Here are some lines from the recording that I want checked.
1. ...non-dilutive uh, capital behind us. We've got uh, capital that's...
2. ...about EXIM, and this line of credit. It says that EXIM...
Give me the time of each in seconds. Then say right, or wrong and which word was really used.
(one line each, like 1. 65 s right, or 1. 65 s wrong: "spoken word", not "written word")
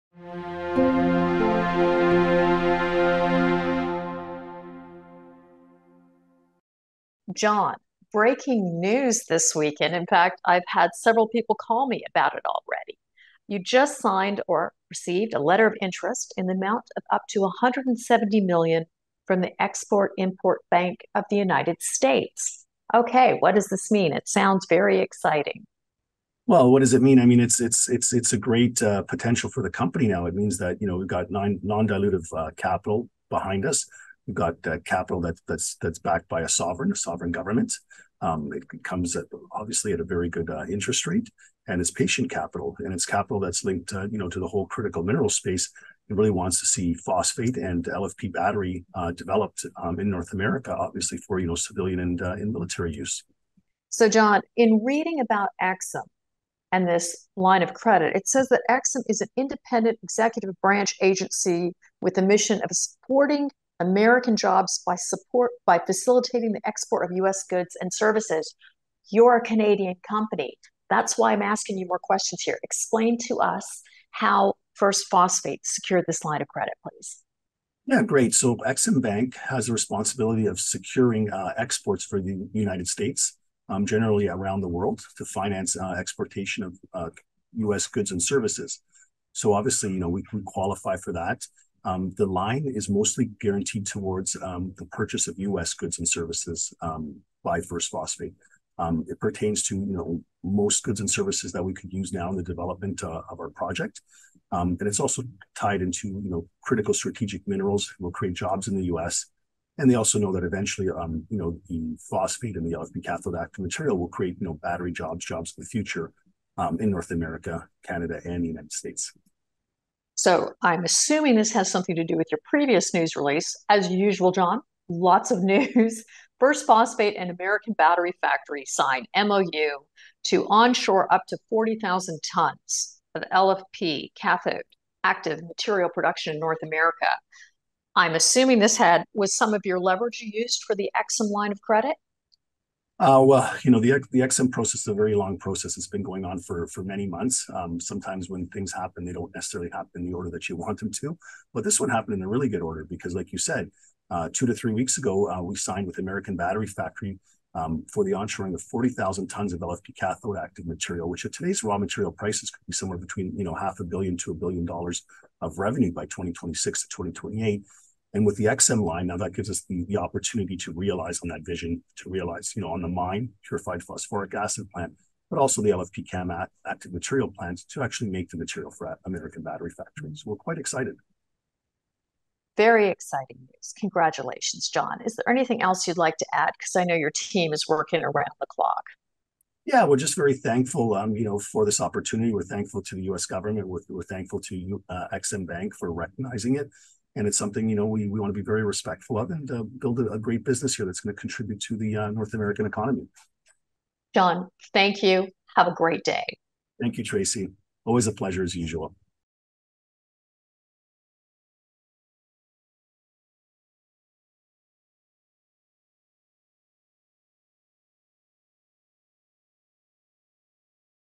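1. 31 s right
2. 55 s right.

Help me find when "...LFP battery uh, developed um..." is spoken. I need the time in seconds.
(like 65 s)
47 s.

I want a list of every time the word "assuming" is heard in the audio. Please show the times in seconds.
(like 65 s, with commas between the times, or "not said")
120 s, 138 s.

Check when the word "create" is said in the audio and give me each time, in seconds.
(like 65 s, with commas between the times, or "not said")
108 s, 114 s.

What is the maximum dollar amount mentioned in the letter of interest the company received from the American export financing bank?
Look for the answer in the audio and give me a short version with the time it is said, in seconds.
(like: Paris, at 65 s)
170 million, at 17 s.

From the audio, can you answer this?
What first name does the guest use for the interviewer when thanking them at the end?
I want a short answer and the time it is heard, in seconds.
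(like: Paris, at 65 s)
Tracy, at 207 s.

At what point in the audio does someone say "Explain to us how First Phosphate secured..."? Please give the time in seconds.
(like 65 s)
72 s.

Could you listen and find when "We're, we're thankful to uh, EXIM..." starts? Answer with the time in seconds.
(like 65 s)
193 s.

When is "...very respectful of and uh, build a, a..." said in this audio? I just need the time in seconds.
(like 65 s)
198 s.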